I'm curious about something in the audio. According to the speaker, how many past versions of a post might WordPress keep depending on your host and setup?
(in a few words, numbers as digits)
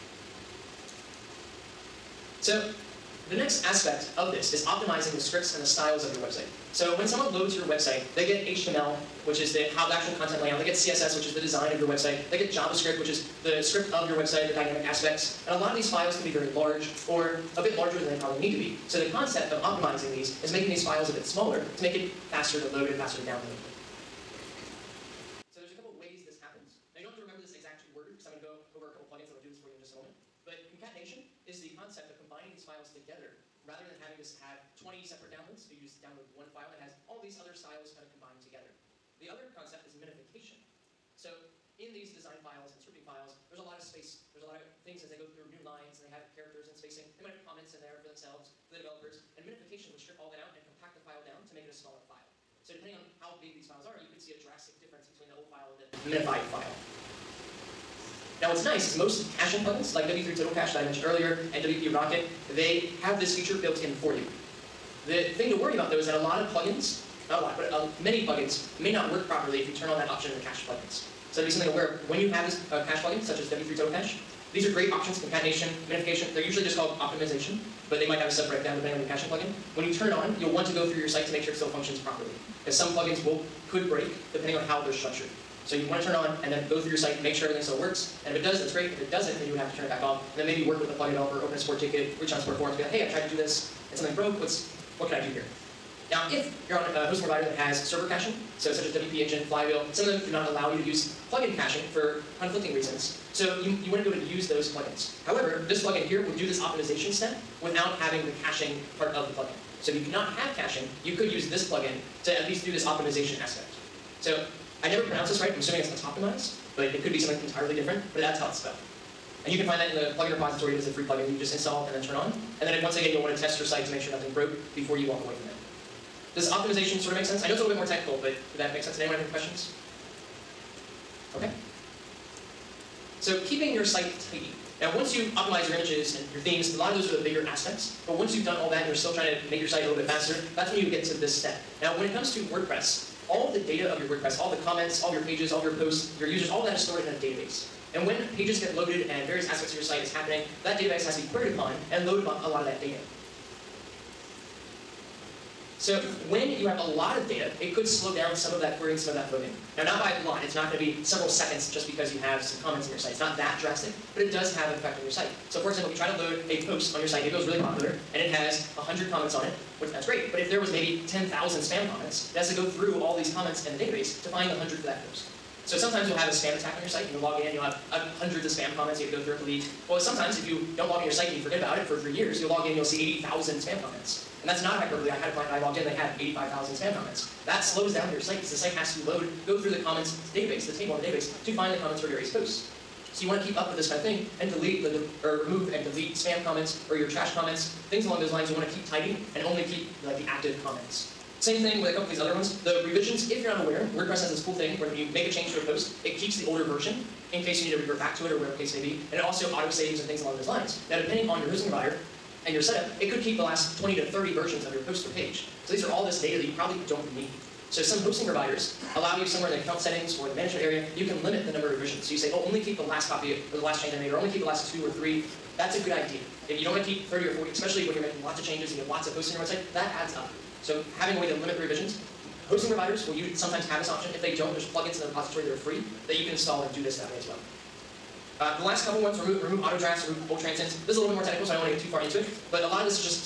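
20 to 30.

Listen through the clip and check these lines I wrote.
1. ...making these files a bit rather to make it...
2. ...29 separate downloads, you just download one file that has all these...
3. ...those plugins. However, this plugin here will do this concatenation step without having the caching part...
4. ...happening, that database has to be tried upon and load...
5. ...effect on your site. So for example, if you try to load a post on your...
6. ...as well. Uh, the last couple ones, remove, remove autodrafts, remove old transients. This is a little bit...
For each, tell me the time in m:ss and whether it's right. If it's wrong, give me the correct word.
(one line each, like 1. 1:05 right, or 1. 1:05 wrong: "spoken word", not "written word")
1. 0:20 wrong: "smaller", not "rather"
2. 0:34 wrong: "20", not "29"
3. 1:44 wrong: "optimization", not "concatenation"
4. 2:30 wrong: "queried", not "tried"
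5. 2:44 right
6. 3:57 right.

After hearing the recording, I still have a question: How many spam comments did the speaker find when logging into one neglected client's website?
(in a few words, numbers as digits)
85,000.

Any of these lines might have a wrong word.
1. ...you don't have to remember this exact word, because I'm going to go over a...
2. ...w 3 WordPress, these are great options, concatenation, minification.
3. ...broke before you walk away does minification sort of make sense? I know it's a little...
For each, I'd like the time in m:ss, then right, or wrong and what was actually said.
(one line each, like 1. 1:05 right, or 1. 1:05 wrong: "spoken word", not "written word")
1. 0:26 right
2. 1:13 wrong: "Cache", not "WordPress"
3. 2:04 wrong: "optimization", not "minification".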